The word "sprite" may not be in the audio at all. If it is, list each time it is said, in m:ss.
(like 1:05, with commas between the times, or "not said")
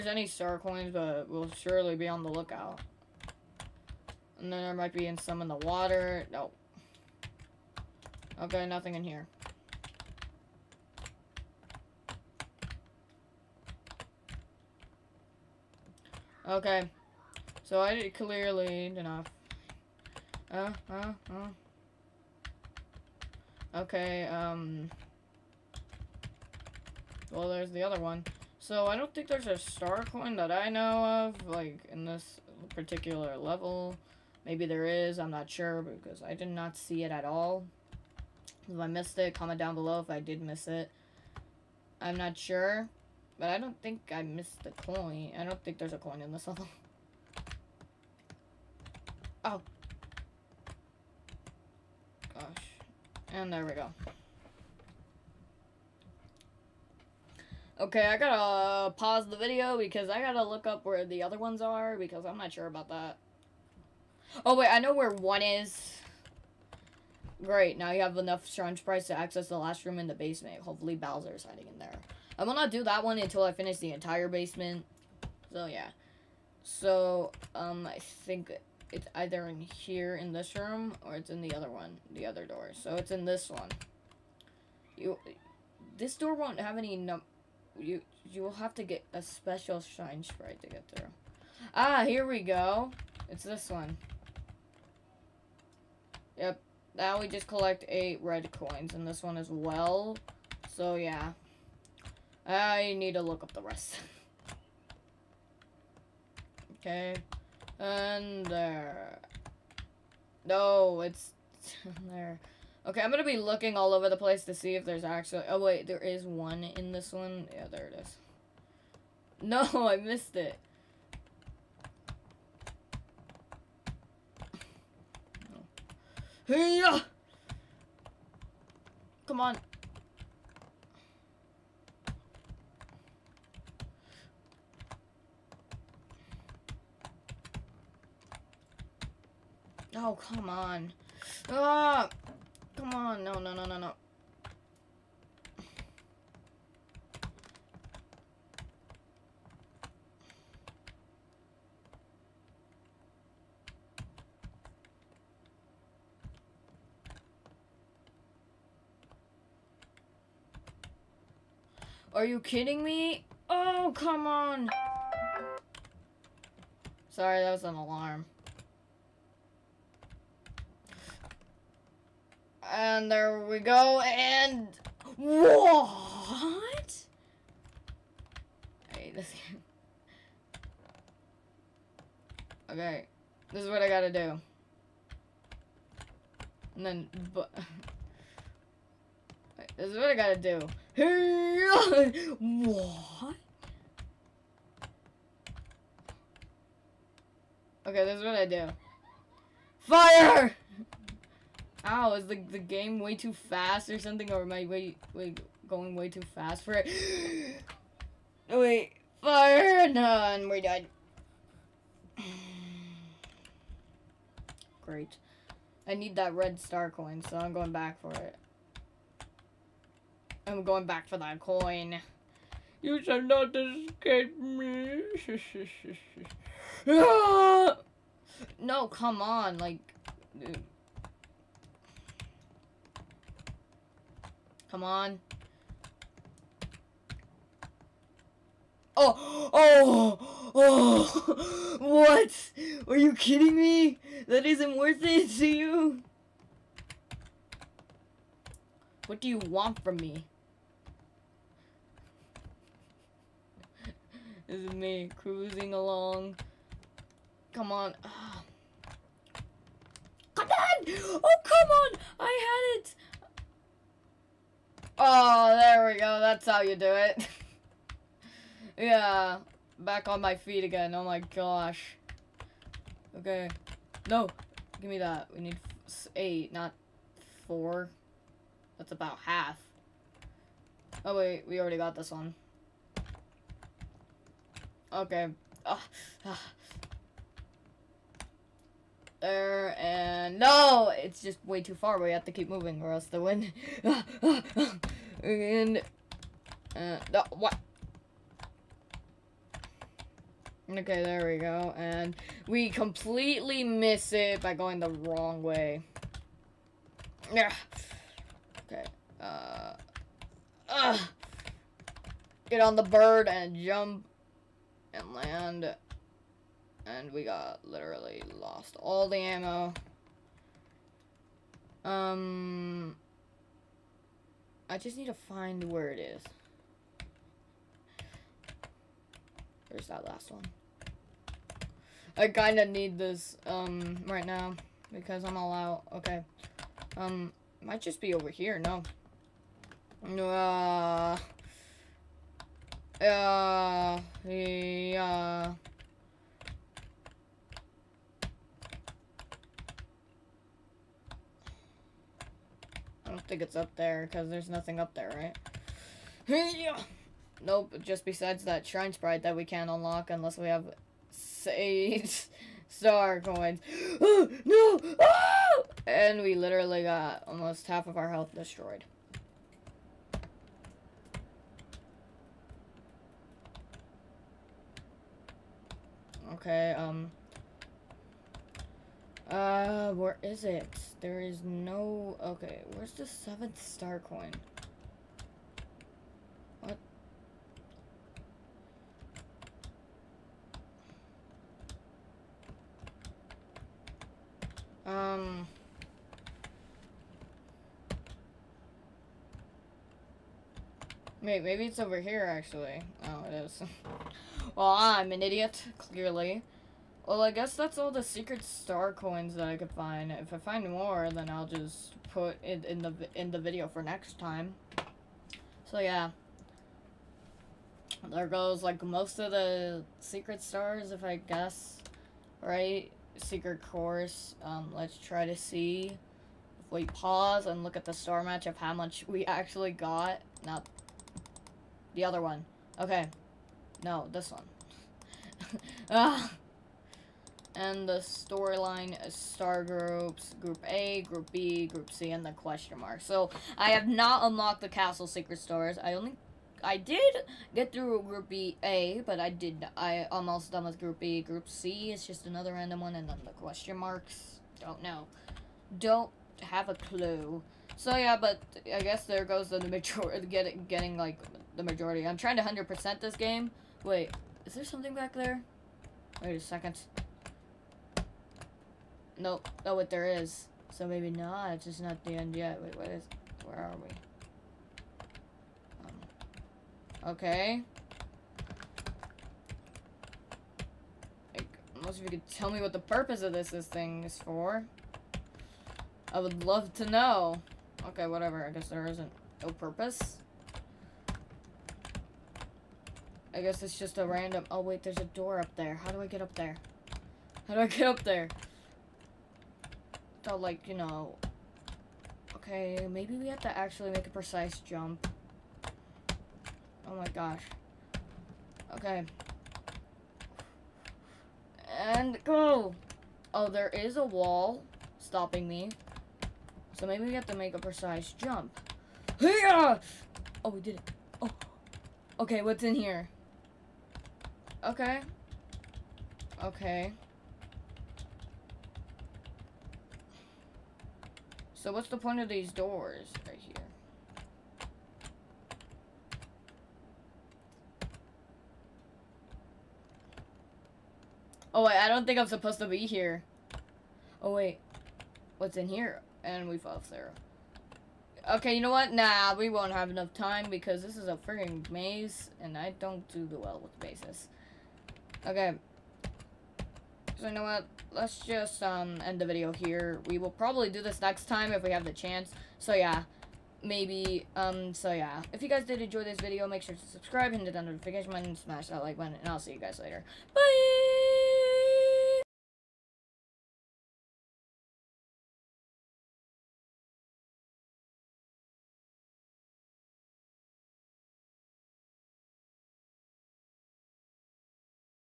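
1:30, 5:58.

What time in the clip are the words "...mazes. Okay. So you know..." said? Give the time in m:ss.
9:13.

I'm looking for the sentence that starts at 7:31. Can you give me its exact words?
Group C is just another random one and then the question marks.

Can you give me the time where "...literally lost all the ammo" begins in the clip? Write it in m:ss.
5:17.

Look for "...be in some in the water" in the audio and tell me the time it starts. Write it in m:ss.
0:04.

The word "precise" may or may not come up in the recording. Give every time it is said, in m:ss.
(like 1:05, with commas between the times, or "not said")
8:24, 8:37.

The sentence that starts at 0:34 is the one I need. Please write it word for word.
Maybe there is, I'm not sure, because I did not see it at all.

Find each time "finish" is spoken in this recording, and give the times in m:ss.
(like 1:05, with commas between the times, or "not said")
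1:13.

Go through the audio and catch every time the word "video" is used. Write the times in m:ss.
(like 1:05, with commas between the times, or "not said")
0:59, 6:53, 9:19, 9:26.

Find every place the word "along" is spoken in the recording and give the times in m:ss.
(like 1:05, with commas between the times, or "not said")
4:15.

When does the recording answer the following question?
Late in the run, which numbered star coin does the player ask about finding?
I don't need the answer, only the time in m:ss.
6:23.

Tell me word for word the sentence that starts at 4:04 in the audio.
That isn't worth it to you.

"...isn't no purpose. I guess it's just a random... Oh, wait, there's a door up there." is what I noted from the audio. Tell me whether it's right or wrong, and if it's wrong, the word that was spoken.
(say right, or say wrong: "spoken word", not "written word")
right.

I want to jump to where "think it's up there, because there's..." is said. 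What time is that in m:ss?
5:53.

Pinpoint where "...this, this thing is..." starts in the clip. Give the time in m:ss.
8:03.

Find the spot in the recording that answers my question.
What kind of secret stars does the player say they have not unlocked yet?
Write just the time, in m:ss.
7:24.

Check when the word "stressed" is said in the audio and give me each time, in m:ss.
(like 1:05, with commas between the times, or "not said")
not said.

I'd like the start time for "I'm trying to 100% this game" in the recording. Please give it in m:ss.
7:42.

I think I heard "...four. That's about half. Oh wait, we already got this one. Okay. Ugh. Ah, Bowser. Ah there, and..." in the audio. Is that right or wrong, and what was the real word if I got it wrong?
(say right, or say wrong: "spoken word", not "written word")
wrong: "Ugh", not "Bowser".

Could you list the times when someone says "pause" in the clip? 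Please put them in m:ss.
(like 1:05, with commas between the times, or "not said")
0:58, 7:06.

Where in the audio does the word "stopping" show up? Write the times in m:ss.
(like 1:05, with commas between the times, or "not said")
8:34.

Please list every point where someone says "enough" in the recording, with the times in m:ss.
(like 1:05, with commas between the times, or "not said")
0:18, 1:08, 9:09.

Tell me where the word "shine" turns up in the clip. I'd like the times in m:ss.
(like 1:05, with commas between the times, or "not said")
1:29, 5:58.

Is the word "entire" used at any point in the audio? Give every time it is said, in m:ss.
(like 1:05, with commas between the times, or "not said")
1:13.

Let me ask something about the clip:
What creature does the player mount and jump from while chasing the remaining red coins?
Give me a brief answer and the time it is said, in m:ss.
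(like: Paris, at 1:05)
Bird, at 5:12.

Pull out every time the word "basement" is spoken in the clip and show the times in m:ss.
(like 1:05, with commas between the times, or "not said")
1:10, 1:14.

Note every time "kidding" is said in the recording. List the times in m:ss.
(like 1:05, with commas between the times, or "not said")
2:42, 4:03.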